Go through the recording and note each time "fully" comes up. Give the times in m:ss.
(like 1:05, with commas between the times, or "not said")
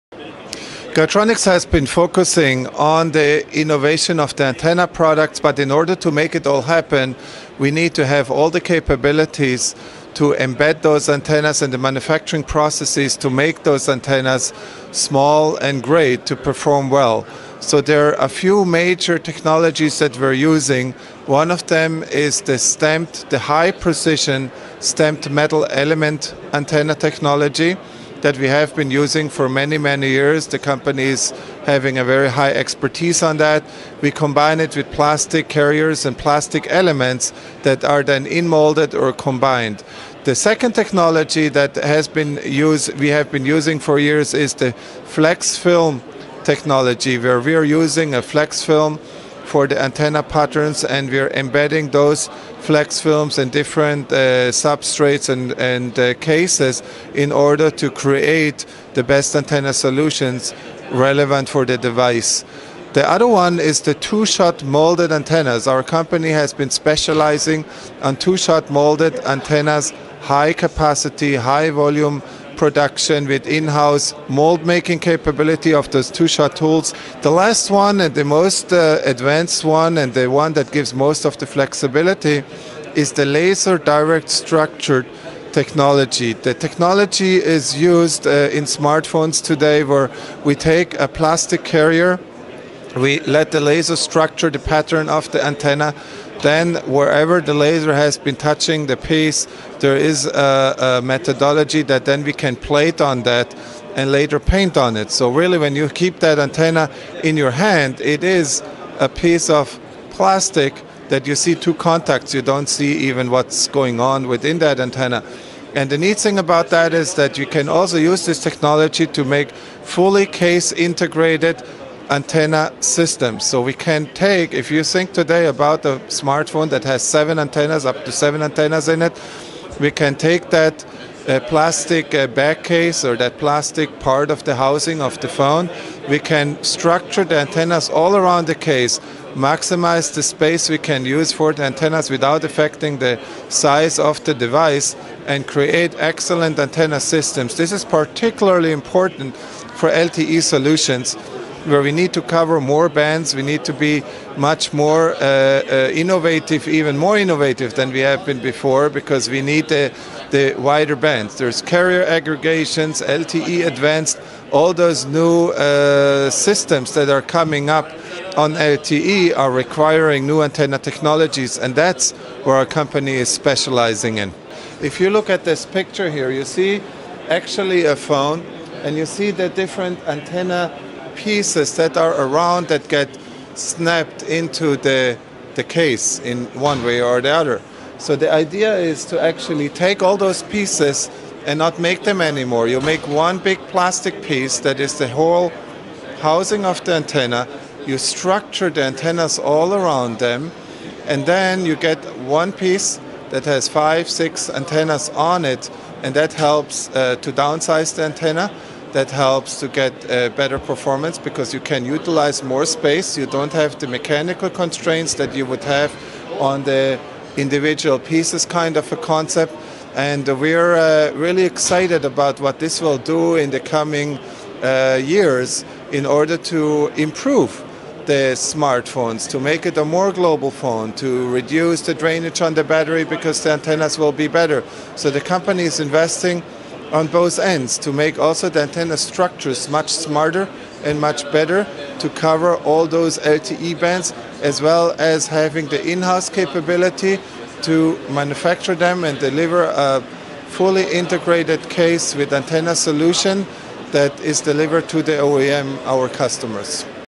1:59, 4:10.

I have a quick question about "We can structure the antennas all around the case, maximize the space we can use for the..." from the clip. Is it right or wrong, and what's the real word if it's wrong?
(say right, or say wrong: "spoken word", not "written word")
right.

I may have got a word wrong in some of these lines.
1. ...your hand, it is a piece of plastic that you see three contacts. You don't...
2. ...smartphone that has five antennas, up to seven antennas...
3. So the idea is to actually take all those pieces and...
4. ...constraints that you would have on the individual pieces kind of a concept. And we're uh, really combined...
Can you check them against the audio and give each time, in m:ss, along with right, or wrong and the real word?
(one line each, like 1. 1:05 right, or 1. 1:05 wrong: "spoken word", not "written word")
1. 1:47 wrong: "two", not "three"
2. 2:06 wrong: "seven", not "five"
3. 3:07 right
4. 3:34 wrong: "excited", not "combined".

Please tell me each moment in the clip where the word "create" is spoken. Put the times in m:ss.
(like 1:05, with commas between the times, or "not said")
0:57, 2:25.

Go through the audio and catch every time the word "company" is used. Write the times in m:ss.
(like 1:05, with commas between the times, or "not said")
0:30, 1:05, 2:52, 3:55.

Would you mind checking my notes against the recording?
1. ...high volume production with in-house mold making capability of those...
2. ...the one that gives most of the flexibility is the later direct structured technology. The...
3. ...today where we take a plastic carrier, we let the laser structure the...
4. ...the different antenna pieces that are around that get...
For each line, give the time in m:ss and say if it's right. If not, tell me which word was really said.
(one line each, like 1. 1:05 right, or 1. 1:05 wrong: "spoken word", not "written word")
1. 1:11 right
2. 1:20 wrong: "laser", not "later"
3. 1:29 right
4. 2:59 right.